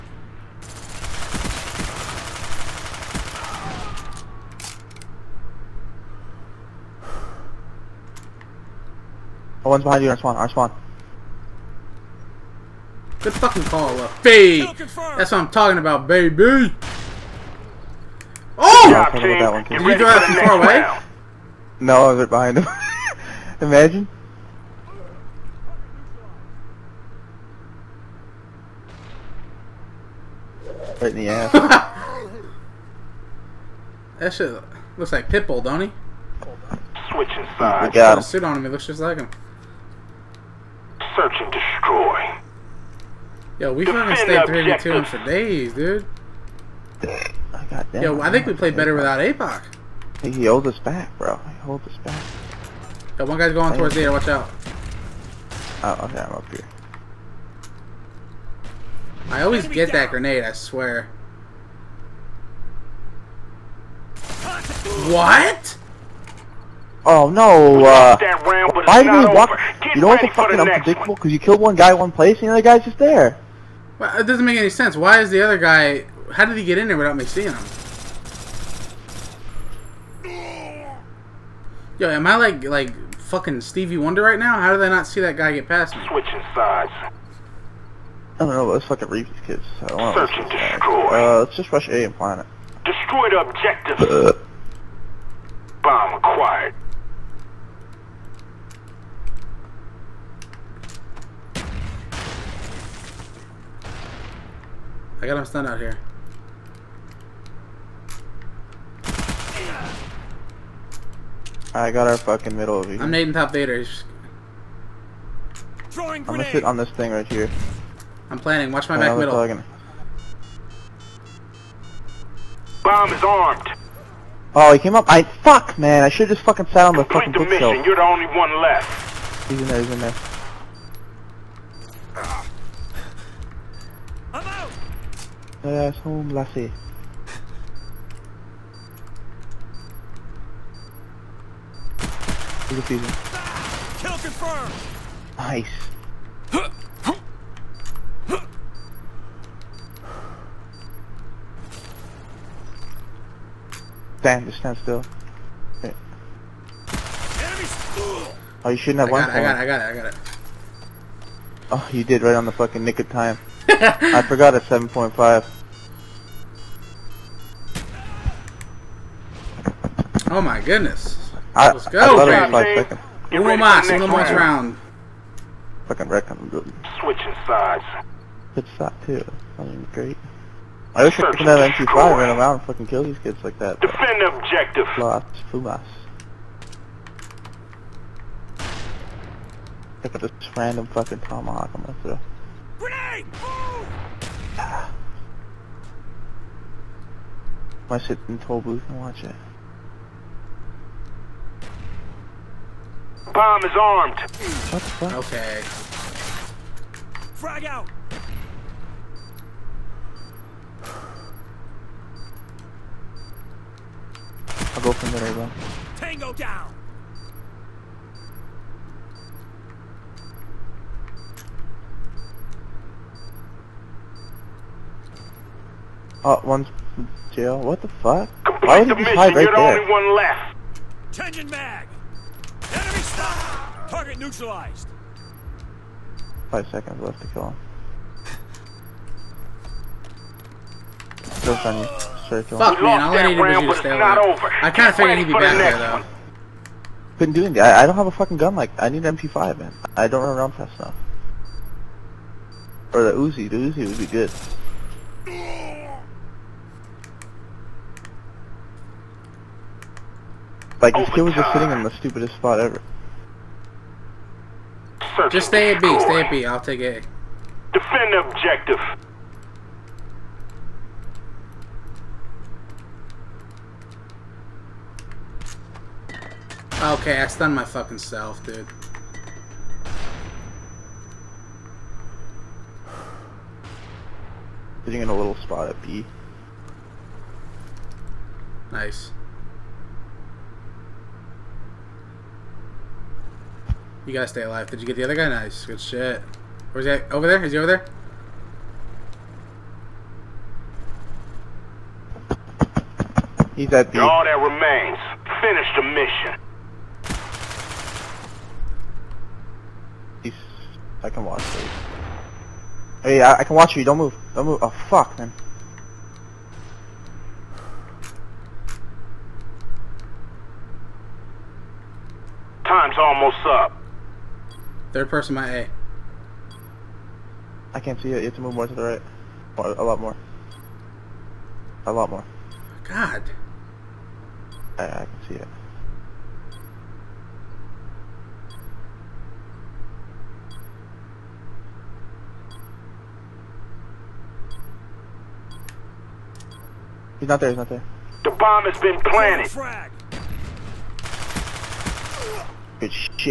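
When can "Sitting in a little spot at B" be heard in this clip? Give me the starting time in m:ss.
4:44.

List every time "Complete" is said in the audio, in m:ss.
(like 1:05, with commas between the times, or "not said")
2:07, 3:48.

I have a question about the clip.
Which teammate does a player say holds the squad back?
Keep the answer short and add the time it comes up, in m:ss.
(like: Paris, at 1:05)
APOC, at 0:49.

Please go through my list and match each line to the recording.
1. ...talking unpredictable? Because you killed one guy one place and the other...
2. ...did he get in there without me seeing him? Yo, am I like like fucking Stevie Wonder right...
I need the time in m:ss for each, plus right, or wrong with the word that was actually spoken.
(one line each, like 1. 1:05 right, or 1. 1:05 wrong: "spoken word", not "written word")
1. 1:10 wrong: "fucking", not "talking"
2. 1:16 right.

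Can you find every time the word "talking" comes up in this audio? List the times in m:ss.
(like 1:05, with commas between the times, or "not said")
0:15, 1:59.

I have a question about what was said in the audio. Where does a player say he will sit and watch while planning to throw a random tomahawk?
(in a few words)
toll booth.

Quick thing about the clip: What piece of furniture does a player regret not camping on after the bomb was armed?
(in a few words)
bookshelf.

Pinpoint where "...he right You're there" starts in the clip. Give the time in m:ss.
3:48.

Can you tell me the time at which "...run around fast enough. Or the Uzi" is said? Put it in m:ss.
4:10.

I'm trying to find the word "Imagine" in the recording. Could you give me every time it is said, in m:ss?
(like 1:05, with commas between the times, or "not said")
0:23.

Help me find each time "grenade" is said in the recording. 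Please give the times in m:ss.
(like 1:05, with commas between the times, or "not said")
1:00, 3:12.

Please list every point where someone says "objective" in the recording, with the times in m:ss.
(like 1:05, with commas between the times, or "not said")
1:33, 3:04, 4:28.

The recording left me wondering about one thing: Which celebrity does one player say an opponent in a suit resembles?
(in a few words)
Pitbull.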